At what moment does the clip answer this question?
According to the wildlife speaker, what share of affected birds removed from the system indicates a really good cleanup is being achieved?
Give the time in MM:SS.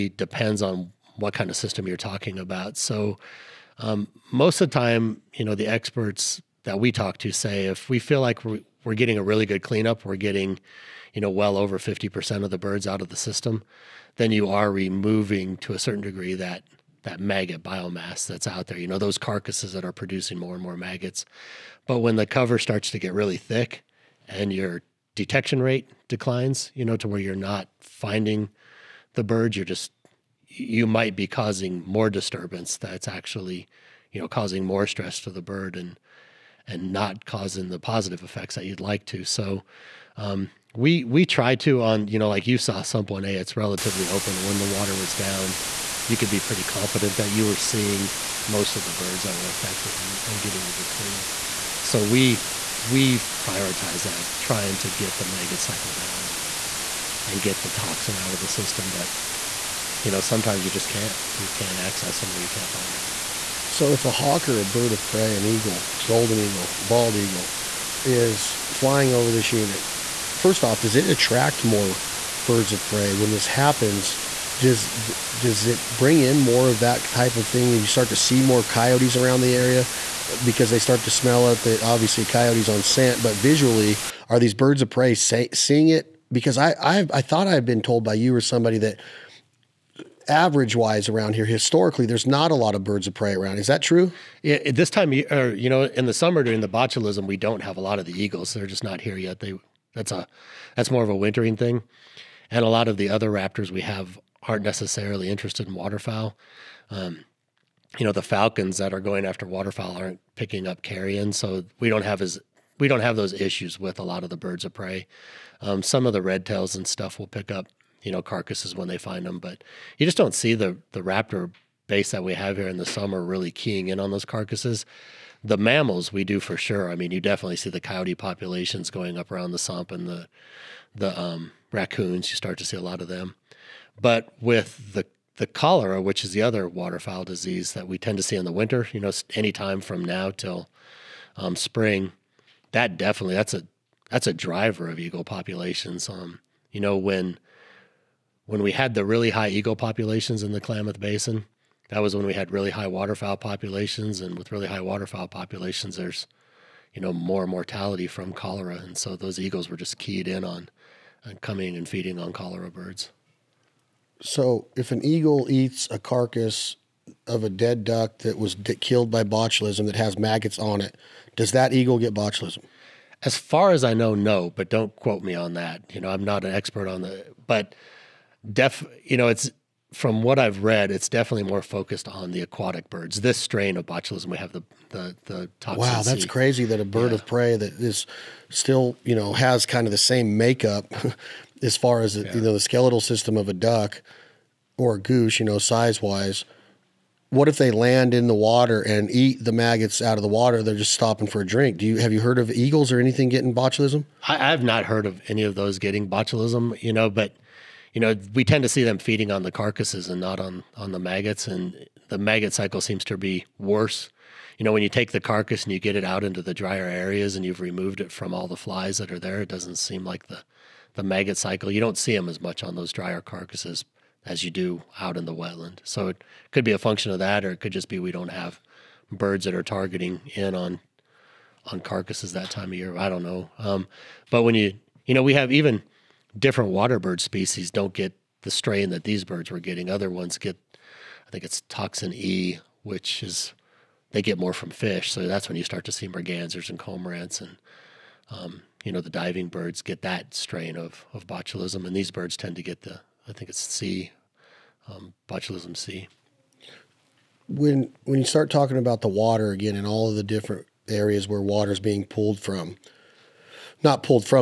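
00:11.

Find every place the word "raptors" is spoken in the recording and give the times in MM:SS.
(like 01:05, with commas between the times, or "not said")
01:43, 02:01.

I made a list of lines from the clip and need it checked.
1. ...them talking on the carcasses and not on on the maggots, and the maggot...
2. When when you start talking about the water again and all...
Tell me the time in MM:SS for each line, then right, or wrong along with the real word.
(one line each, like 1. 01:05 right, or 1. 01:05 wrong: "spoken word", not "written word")
1. 03:28 wrong: "feeding", not "talking"
2. 04:17 right.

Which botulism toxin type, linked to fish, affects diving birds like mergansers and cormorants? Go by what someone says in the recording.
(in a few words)
toxin E.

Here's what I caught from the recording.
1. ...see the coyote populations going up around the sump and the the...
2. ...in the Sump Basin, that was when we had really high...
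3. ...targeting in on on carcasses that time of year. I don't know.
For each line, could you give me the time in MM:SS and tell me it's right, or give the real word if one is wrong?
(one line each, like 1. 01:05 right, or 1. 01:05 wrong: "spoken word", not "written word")
1. 02:07 right
2. 02:30 wrong: "Klamath", not "Sump"
3. 03:49 right.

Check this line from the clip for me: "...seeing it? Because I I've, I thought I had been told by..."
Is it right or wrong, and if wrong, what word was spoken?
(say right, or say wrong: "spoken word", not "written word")
right.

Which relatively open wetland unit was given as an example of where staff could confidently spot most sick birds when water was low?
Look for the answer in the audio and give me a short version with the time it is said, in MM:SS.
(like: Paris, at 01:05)
Sump 1A, at 00:42.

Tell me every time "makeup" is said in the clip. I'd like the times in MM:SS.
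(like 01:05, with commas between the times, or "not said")
03:10.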